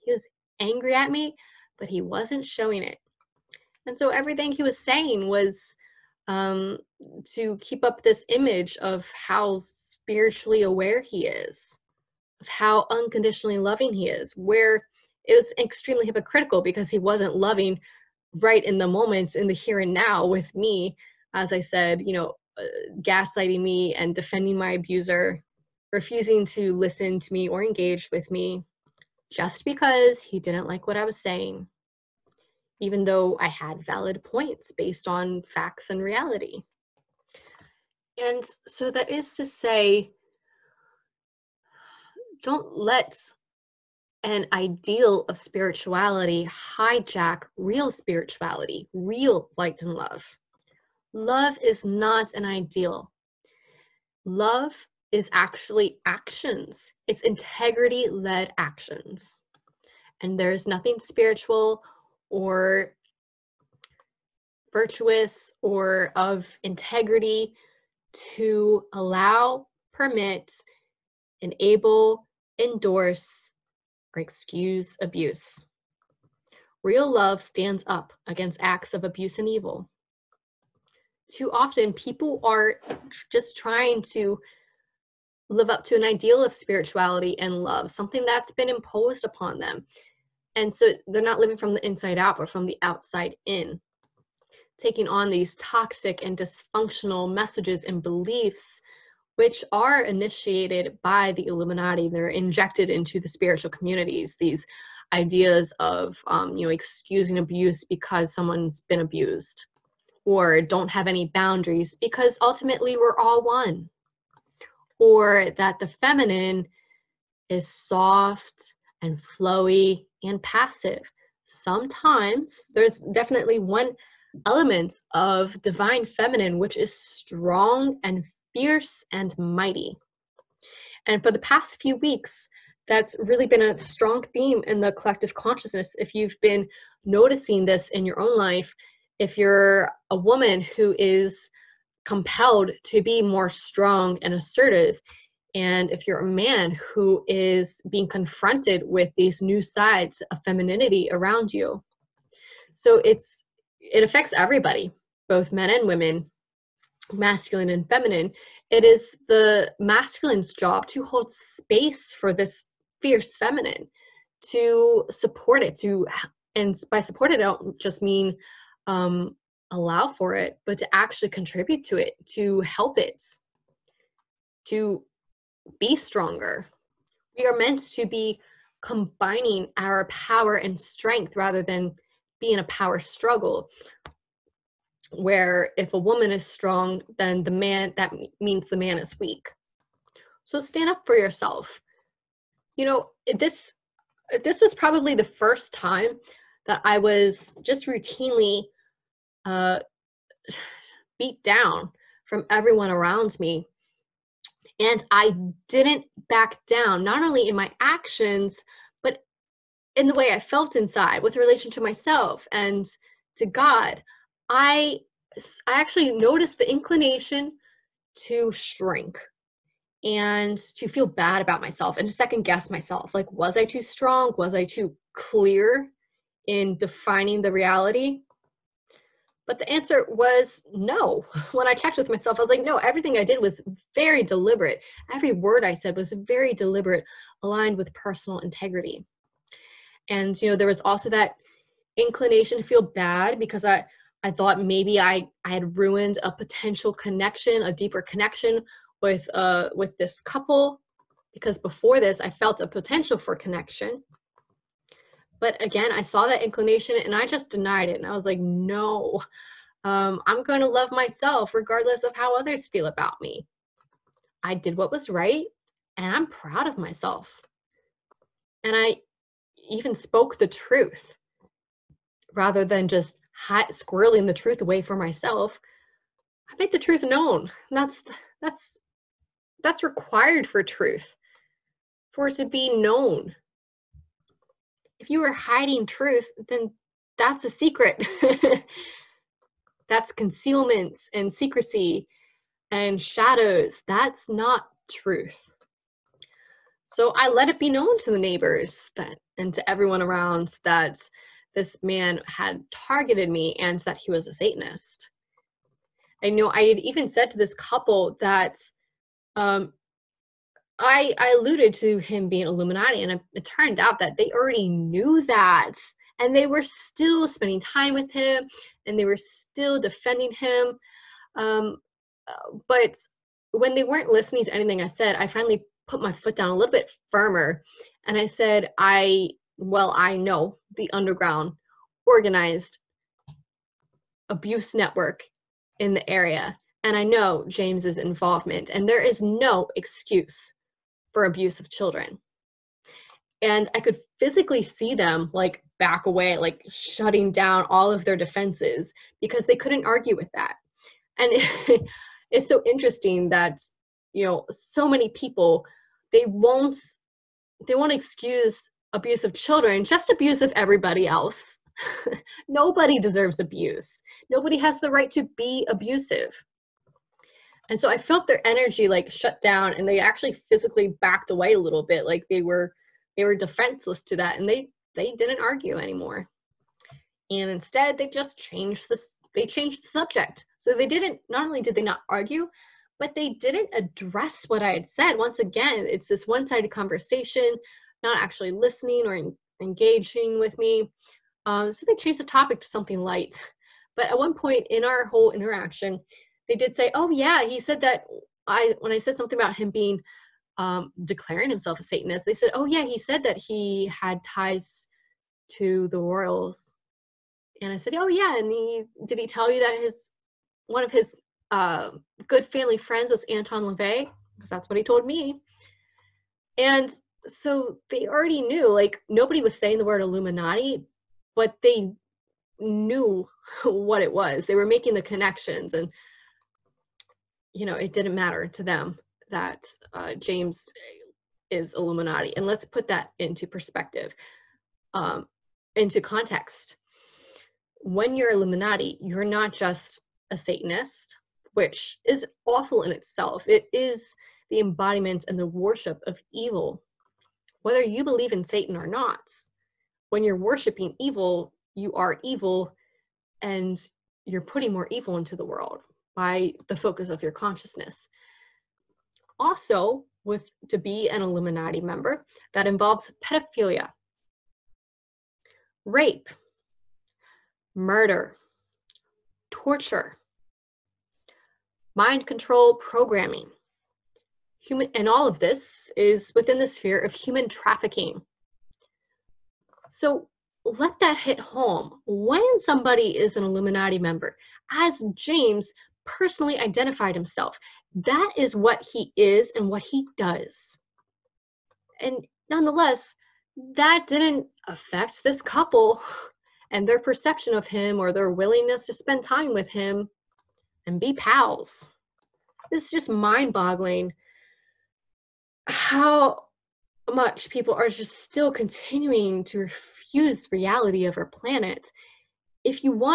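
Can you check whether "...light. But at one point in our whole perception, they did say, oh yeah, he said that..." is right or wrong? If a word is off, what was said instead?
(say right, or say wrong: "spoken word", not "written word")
wrong: "interaction", not "perception".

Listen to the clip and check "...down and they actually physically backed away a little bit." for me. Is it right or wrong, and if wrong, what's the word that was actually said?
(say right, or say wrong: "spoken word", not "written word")
right.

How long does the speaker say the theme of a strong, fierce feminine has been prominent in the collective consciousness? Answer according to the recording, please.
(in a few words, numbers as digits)
past few weeks.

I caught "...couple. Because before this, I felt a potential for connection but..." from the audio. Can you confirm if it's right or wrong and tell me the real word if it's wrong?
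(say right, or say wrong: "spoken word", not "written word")
right.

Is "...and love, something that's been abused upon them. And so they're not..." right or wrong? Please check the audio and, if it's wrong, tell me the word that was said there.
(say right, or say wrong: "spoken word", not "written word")
wrong: "imposed", not "abused".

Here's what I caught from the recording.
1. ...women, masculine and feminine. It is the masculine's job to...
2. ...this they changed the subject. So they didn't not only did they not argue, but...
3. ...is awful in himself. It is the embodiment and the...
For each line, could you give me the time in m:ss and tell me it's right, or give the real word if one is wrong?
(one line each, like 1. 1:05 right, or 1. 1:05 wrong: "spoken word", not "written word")
1. 2:35 right
2. 6:18 right
3. 7:22 wrong: "itself", not "himself".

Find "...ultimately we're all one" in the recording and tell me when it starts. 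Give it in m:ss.
1:52.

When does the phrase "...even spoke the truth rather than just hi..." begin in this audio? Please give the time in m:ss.
4:29.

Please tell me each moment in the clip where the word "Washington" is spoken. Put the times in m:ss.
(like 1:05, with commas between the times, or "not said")
not said.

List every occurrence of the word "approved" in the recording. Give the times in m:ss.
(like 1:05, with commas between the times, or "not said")
not said.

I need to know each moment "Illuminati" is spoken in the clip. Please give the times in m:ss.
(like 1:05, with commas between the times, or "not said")
1:41, 5:12, 7:00, 7:11, 7:18, 7:41, 8:03.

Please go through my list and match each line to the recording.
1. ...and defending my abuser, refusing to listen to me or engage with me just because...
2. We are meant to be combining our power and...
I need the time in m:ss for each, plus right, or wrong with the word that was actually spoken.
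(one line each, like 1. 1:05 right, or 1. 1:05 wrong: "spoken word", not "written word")
1. 0:23 right
2. 2:57 right.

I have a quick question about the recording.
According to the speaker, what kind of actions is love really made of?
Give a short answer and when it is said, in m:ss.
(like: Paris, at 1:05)
integrity led actions, at 0:57.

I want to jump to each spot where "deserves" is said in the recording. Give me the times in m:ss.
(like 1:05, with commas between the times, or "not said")
6:02.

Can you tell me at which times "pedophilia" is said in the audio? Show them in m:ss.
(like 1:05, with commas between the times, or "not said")
7:43.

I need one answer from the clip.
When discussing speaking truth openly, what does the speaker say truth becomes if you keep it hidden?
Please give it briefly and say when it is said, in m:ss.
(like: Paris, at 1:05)
a secret, at 4:47.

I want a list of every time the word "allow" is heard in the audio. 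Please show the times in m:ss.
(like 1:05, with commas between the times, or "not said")
1:08, 2:49.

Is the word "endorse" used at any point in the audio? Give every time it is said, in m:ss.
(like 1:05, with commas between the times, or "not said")
1:12.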